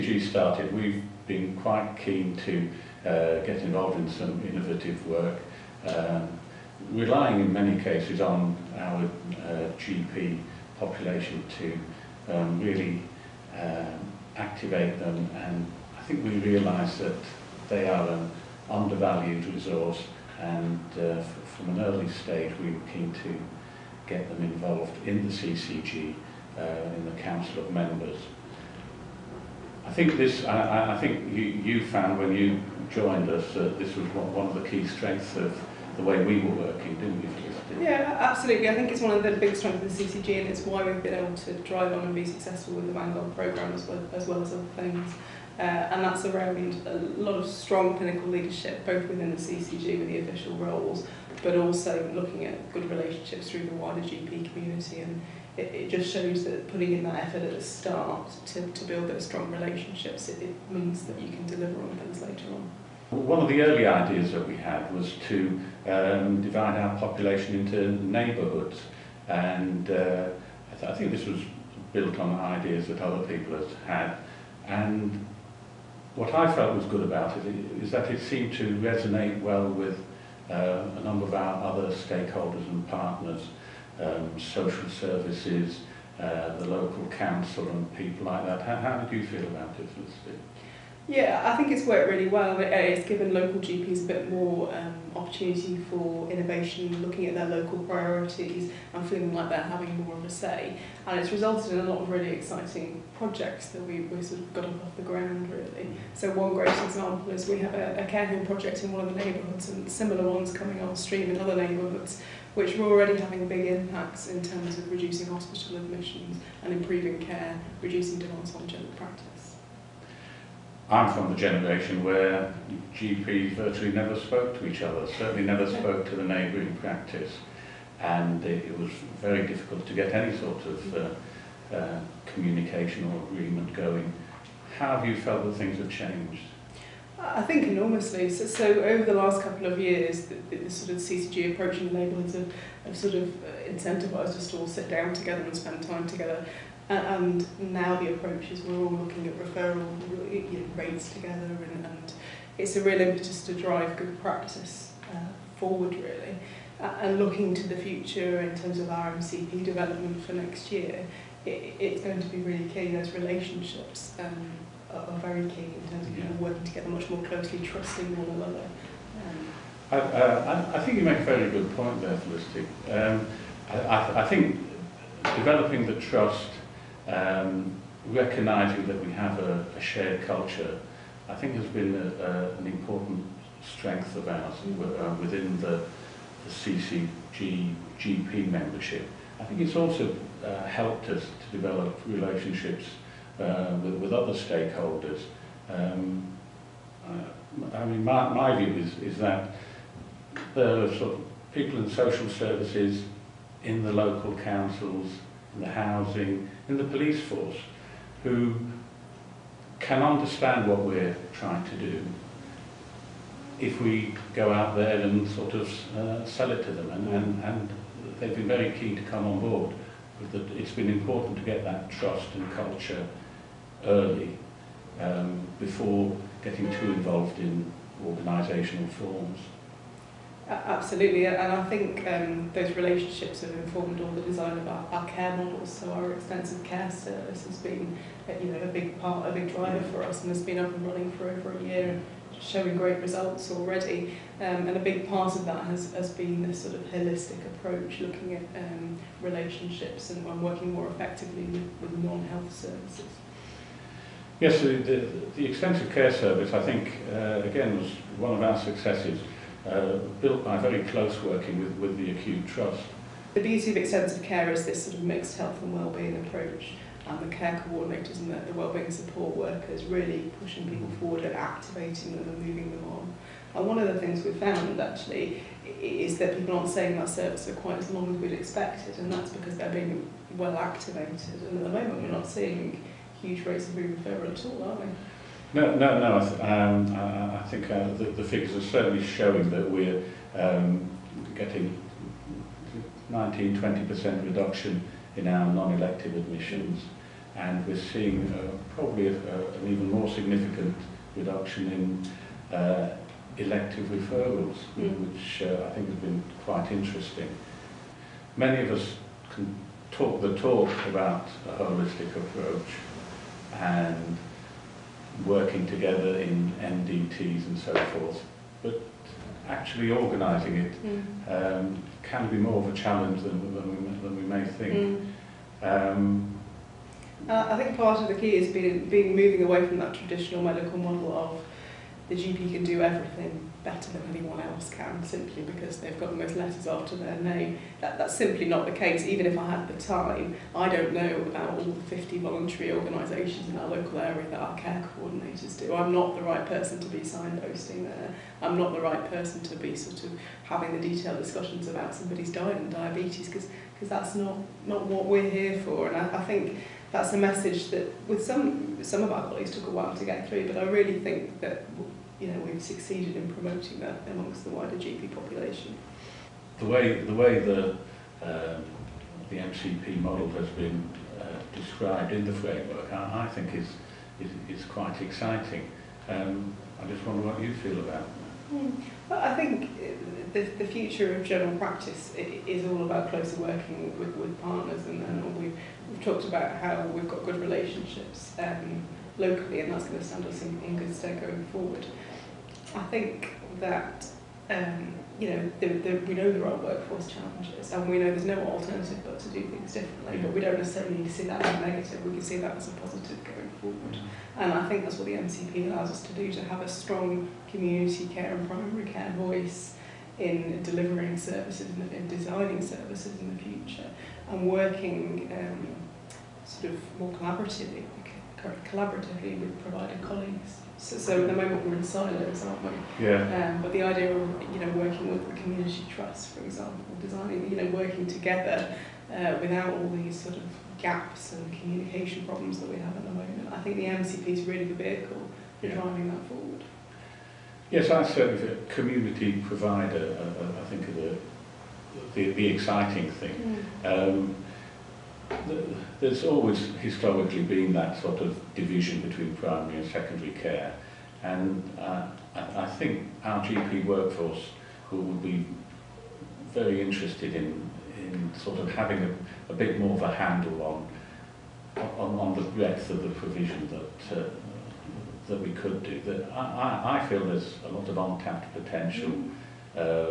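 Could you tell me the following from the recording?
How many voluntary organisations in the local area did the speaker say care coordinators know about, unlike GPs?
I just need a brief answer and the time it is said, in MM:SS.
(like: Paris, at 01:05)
50, at 05:41.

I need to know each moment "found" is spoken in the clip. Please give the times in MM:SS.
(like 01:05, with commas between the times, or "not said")
00:31, 04:34.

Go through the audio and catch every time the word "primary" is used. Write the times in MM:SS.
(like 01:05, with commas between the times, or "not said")
06:48, 07:29.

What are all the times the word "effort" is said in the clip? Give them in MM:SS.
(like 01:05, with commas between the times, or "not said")
00:57.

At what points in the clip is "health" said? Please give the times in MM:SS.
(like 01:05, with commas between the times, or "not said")
04:12, 04:25.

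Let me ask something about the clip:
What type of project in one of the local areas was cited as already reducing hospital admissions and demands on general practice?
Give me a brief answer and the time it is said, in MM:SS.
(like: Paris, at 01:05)
Care home project, at 01:48.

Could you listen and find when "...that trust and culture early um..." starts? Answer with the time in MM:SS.
03:41.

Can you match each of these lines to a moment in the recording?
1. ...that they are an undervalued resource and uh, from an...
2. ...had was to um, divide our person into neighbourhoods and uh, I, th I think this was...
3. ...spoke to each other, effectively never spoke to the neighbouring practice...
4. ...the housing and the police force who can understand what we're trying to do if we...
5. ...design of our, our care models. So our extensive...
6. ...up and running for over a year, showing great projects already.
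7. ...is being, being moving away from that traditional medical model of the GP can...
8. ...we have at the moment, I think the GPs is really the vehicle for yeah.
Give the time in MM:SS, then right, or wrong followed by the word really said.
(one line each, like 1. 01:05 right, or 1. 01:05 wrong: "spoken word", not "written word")
1. 00:16 right
2. 01:04 wrong: "population", not "person"
3. 02:04 wrong: "certainly", not "effectively"
4. 03:25 right
5. 03:54 right
6. 04:00 wrong: "results", not "projects"
7. 05:28 right
8. 07:12 wrong: "MCP", not "GPs".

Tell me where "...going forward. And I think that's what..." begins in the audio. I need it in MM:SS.
06:43.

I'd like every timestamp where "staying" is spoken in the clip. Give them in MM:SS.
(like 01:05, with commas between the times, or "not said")
04:36.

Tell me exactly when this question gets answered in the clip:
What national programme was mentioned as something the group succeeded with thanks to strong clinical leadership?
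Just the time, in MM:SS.
00:42.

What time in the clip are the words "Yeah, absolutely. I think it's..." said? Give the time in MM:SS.
00:37.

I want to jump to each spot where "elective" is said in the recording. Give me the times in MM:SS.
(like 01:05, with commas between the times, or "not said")
04:55, 05:03.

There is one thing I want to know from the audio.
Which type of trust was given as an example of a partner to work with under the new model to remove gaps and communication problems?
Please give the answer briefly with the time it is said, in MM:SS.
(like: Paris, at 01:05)
Community trust, at 07:05.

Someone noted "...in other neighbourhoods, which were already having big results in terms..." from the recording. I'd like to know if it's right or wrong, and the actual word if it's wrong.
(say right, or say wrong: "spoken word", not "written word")
wrong: "impacts", not "results".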